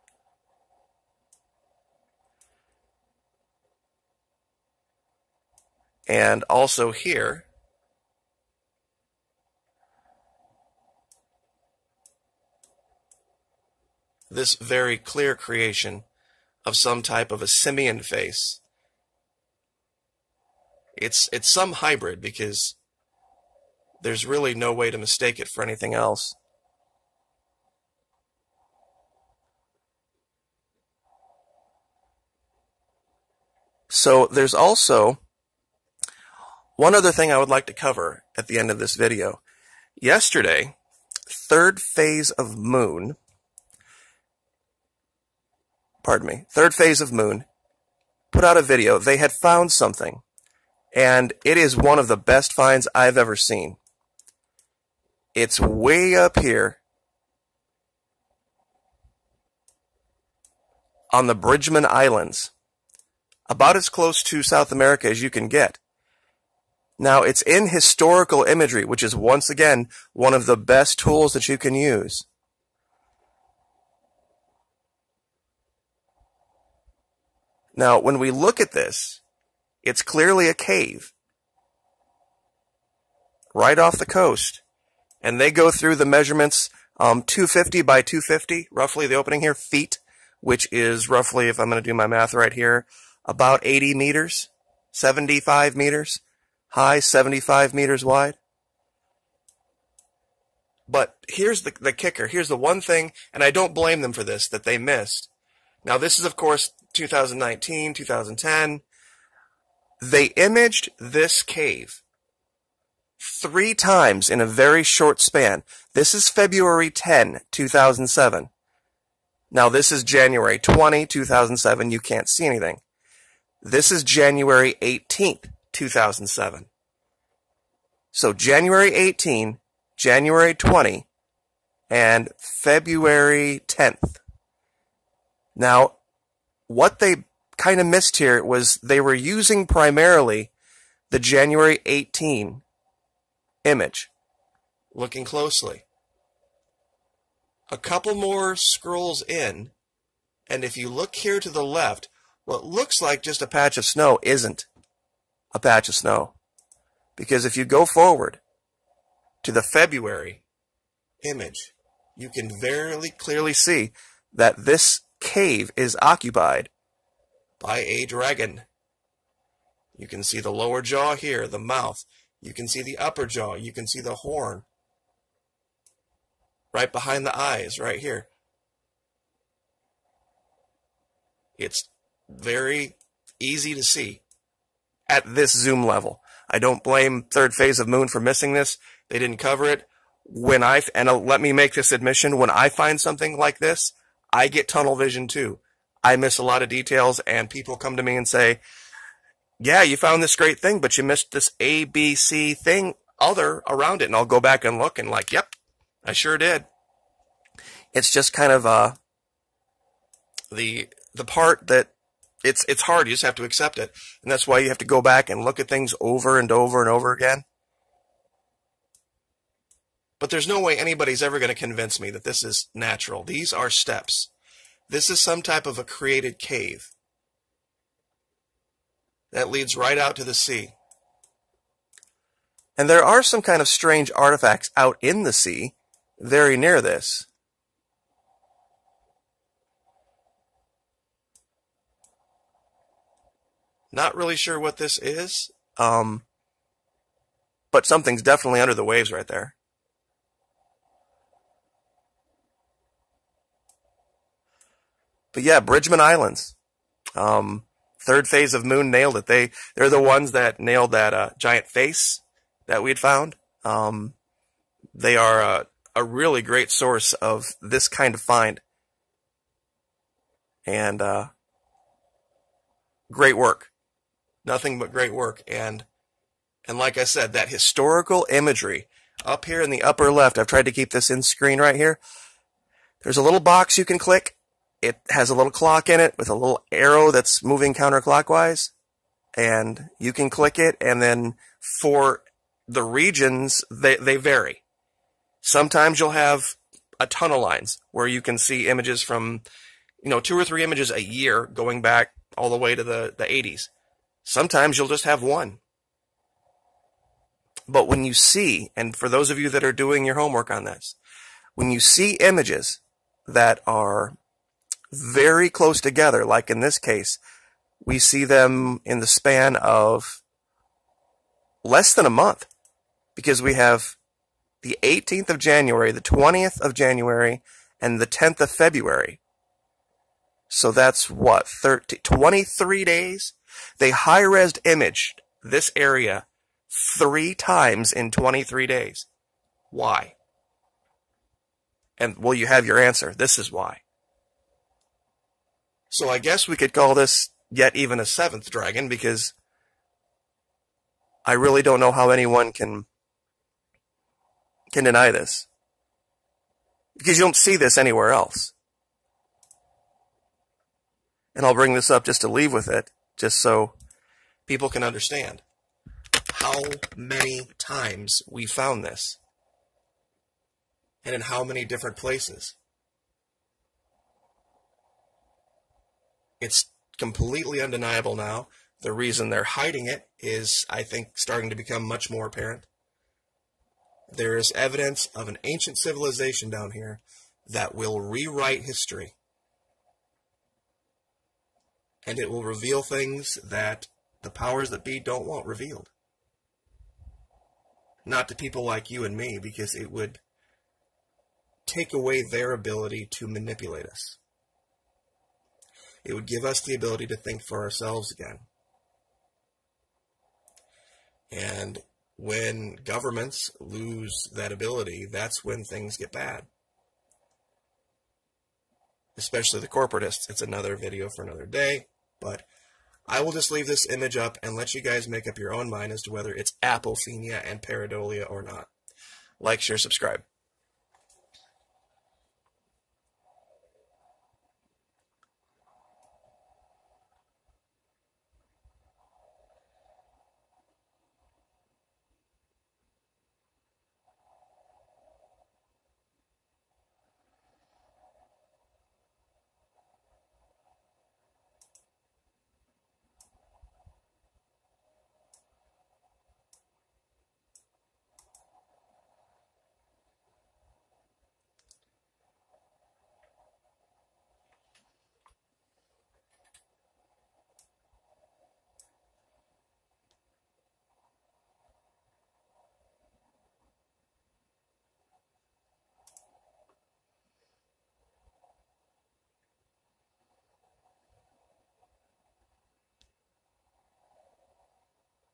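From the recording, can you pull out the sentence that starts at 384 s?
There is evidence of an ancient civilization down here that will rewrite history.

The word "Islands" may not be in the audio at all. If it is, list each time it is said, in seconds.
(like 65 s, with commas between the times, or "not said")
61 s, 256 s.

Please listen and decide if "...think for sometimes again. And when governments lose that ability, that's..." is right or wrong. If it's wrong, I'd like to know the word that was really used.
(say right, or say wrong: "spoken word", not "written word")
wrong: "ourselves", not "sometimes".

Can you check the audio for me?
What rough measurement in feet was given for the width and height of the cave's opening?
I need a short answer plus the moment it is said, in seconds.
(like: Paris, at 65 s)
250 by 250, at 87 s.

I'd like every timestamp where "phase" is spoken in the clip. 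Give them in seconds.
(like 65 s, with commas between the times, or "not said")
41 s, 46 s, 187 s, 258 s.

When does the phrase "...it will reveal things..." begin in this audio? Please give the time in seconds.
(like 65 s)
392 s.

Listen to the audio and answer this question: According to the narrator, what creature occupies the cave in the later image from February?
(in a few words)
A dragon.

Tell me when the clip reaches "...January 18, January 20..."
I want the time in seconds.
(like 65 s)
128 s.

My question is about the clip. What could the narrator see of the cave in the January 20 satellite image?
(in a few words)
Nothing.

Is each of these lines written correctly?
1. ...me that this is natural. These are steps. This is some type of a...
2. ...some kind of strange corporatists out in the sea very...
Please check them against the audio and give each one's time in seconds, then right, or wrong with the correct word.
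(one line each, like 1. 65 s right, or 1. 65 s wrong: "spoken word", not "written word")
1. 222 s right
2. 233 s wrong: "artifacts", not "corporatists".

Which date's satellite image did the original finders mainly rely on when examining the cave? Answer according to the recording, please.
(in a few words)
January 18.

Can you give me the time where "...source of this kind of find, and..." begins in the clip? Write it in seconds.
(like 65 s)
266 s.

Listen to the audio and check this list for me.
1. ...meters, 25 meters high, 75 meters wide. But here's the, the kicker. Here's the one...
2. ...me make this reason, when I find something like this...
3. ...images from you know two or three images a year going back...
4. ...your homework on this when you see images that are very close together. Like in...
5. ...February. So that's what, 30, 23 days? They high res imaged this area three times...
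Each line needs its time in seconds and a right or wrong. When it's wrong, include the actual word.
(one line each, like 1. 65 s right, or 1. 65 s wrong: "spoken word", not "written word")
1. 93 s wrong: "75", not "25"
2. 191 s wrong: "admission", not "reason"
3. 298 s right
4. 310 s right
5. 328 s right.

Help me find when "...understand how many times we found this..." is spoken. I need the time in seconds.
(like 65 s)
364 s.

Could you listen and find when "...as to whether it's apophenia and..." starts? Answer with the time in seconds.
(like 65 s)
425 s.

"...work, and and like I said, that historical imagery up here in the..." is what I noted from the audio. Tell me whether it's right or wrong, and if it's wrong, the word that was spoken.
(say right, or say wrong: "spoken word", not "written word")
right.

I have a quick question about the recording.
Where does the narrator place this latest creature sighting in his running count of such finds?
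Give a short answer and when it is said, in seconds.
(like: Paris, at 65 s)
Seventh, at 348 s.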